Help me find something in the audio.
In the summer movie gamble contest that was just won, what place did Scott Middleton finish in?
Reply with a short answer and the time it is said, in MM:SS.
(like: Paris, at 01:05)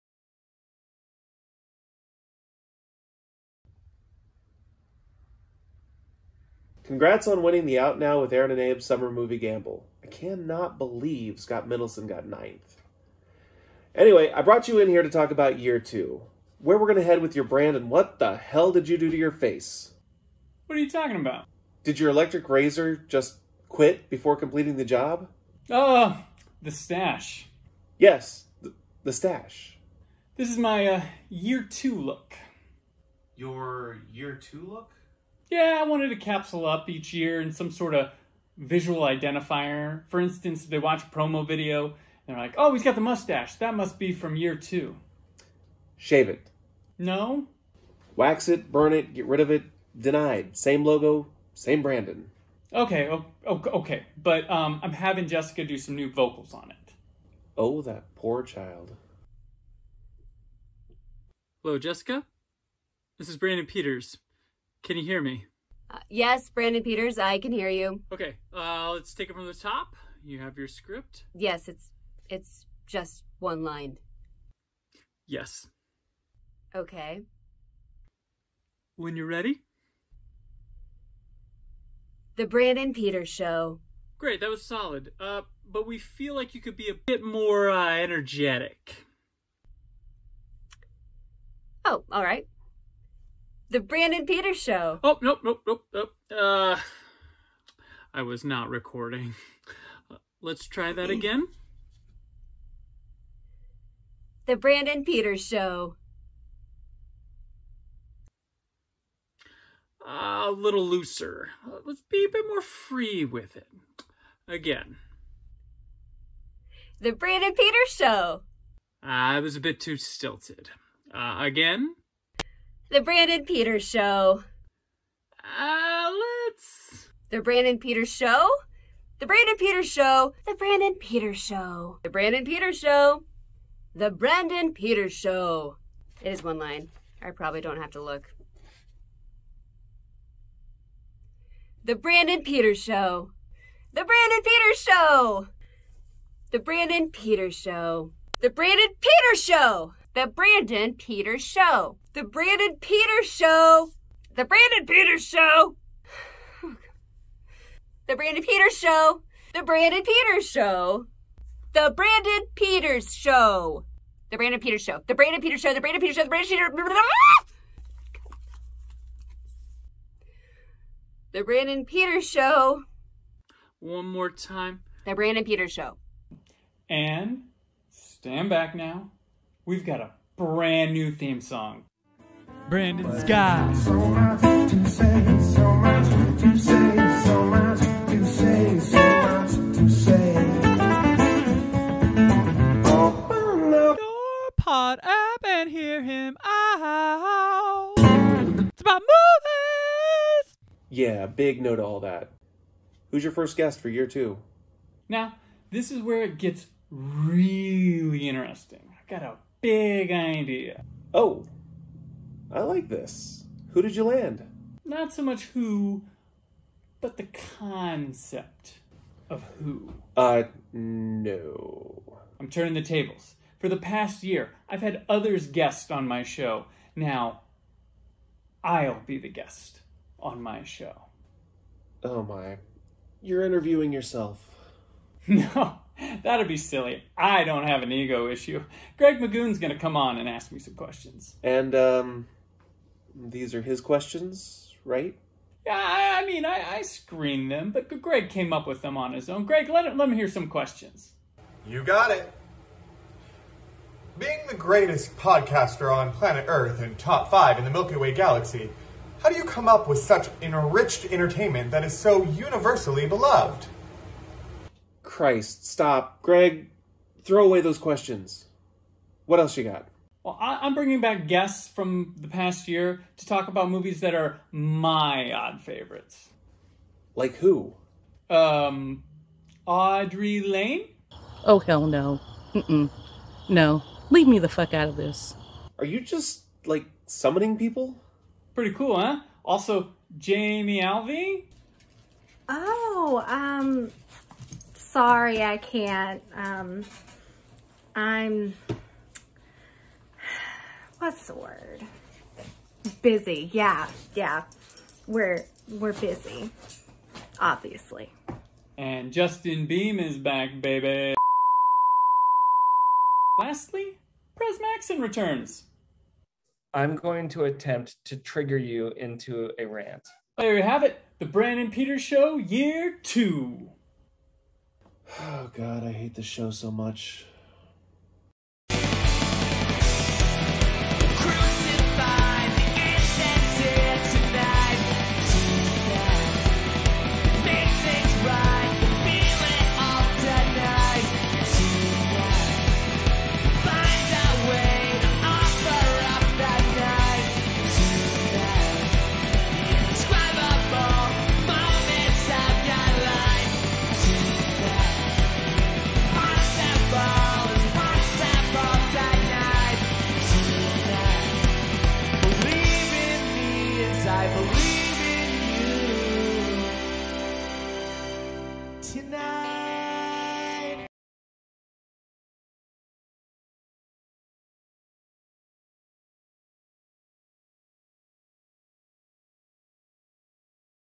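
9th, at 00:12.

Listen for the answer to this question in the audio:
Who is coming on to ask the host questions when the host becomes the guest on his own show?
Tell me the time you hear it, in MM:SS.
03:58.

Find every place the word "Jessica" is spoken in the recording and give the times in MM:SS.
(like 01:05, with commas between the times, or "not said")
00:55, 01:01.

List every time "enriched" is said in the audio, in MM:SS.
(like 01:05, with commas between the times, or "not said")
04:20.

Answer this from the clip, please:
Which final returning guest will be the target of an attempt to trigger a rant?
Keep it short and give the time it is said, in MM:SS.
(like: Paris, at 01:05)
Pres Maxson, at 05:14.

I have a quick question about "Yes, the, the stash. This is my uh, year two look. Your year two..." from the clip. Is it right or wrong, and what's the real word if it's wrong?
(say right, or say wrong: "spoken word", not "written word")
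right.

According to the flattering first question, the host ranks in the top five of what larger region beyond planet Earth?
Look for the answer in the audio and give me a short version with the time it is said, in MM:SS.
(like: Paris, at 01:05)
Milky Way galaxy, at 04:17.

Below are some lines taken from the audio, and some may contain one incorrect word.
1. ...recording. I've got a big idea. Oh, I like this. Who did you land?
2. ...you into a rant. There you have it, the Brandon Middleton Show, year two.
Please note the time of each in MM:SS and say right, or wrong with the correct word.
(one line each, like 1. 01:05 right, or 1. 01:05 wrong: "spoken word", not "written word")
1. 03:28 wrong: "interesting", not "recording"
2. 05:18 wrong: "Peters", not "Middleton".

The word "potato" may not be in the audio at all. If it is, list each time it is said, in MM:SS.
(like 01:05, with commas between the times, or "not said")
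not said.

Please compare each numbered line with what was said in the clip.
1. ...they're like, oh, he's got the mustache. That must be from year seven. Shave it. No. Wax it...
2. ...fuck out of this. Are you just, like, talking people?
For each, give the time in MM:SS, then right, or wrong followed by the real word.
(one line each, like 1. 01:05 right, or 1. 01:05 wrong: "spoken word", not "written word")
1. 00:42 wrong: "two", not "seven"
2. 04:44 wrong: "summoning", not "talking".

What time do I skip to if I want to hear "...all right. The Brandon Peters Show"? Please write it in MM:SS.
01:32.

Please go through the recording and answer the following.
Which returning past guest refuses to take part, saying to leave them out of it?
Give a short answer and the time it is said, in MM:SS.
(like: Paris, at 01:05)
Audery Lane, at 04:39.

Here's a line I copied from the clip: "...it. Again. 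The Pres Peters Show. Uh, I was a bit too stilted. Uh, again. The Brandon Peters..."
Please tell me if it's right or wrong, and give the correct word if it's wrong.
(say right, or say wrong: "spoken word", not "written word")
wrong: "Brandon", not "Pres".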